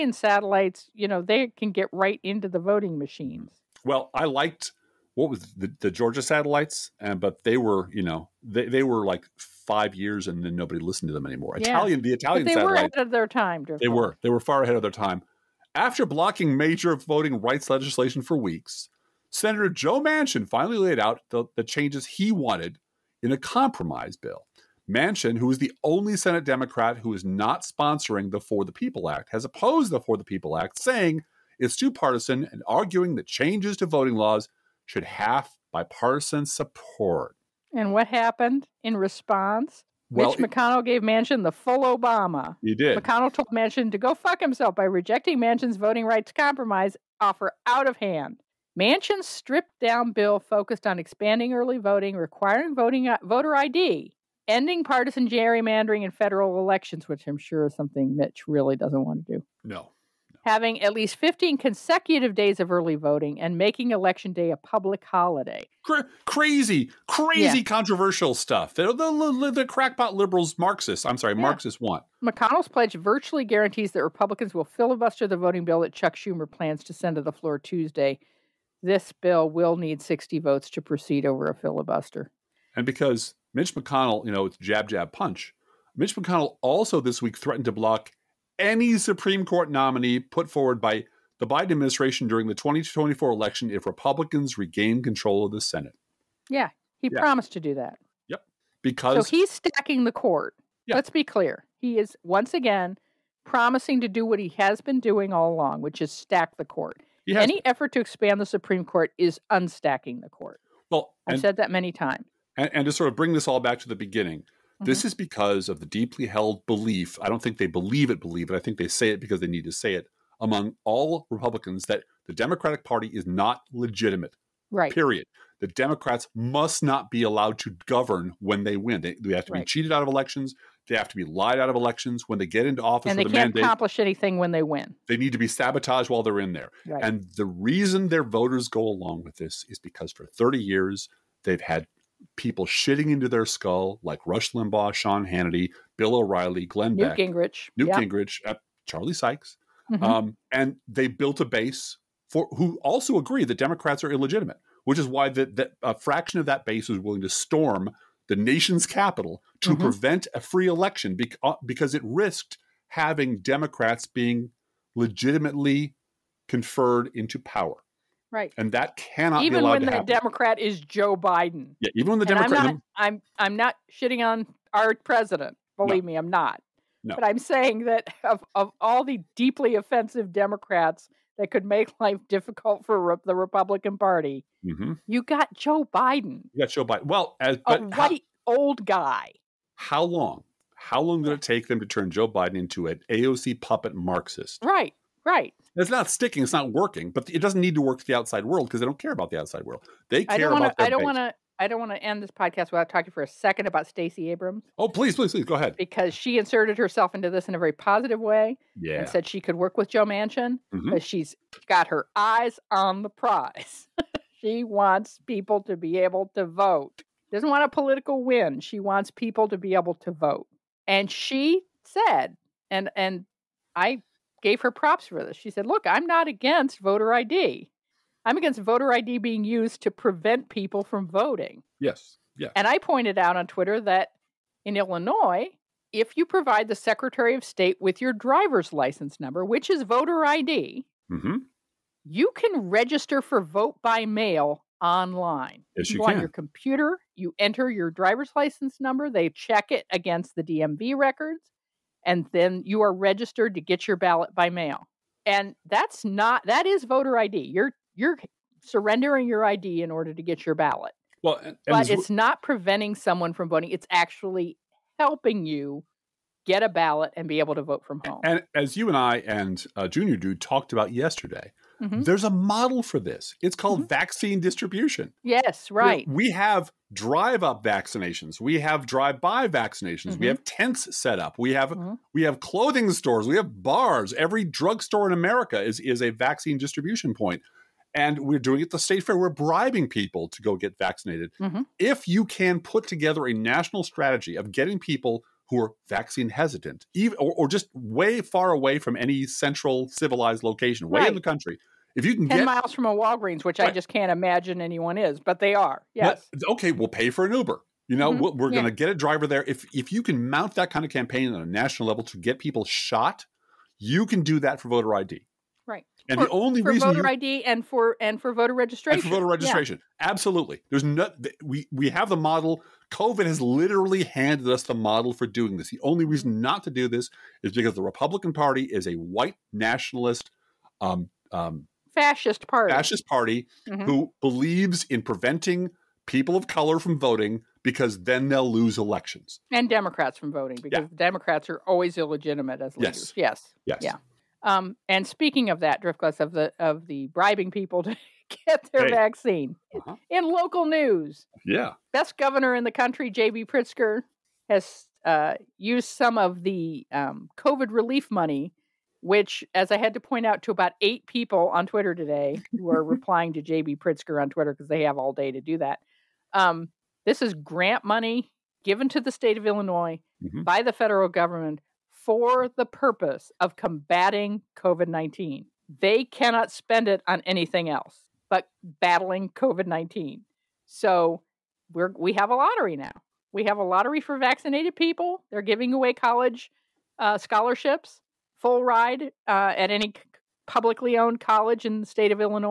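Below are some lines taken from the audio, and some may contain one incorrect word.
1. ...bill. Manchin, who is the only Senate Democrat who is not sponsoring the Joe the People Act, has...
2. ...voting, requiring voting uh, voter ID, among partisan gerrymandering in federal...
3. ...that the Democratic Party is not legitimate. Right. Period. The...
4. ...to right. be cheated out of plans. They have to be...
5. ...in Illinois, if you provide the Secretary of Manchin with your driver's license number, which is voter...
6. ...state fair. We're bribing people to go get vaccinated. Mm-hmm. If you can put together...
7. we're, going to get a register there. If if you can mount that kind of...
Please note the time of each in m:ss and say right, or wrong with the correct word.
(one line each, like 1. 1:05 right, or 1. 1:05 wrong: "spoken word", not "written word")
1. 0:24 wrong: "For", not "Joe"
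2. 0:51 wrong: "ending", not "among"
3. 2:01 right
4. 2:09 wrong: "elections", not "plans"
5. 3:54 wrong: "State", not "Manchin"
6. 4:48 right
7. 5:08 wrong: "driver", not "register".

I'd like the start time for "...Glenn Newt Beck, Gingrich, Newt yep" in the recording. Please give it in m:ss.
2:26.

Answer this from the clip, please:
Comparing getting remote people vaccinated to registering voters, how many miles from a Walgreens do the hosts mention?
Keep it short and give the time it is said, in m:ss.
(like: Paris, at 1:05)
10, at 5:02.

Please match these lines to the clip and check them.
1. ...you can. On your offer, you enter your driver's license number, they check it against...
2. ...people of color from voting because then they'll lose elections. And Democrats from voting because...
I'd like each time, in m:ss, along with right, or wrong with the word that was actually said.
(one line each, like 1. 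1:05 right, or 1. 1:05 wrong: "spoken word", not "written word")
1. 4:05 wrong: "computer", not "offer"
2. 5:36 right.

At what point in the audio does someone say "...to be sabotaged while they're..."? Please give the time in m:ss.
2:15.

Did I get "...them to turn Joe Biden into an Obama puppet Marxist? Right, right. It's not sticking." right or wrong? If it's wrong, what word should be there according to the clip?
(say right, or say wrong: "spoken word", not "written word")
wrong: "AOC", not "Obama".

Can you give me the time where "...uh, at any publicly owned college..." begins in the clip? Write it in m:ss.
6:29.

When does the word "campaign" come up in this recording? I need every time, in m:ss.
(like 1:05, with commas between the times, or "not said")
5:10.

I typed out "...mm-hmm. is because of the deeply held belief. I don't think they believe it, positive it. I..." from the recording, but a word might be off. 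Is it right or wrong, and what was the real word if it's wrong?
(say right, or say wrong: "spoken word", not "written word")
wrong: "believe", not "positive".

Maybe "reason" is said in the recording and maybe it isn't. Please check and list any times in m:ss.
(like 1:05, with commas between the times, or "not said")
2:17, 5:16, 5:26.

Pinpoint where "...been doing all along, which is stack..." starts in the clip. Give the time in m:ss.
1:44.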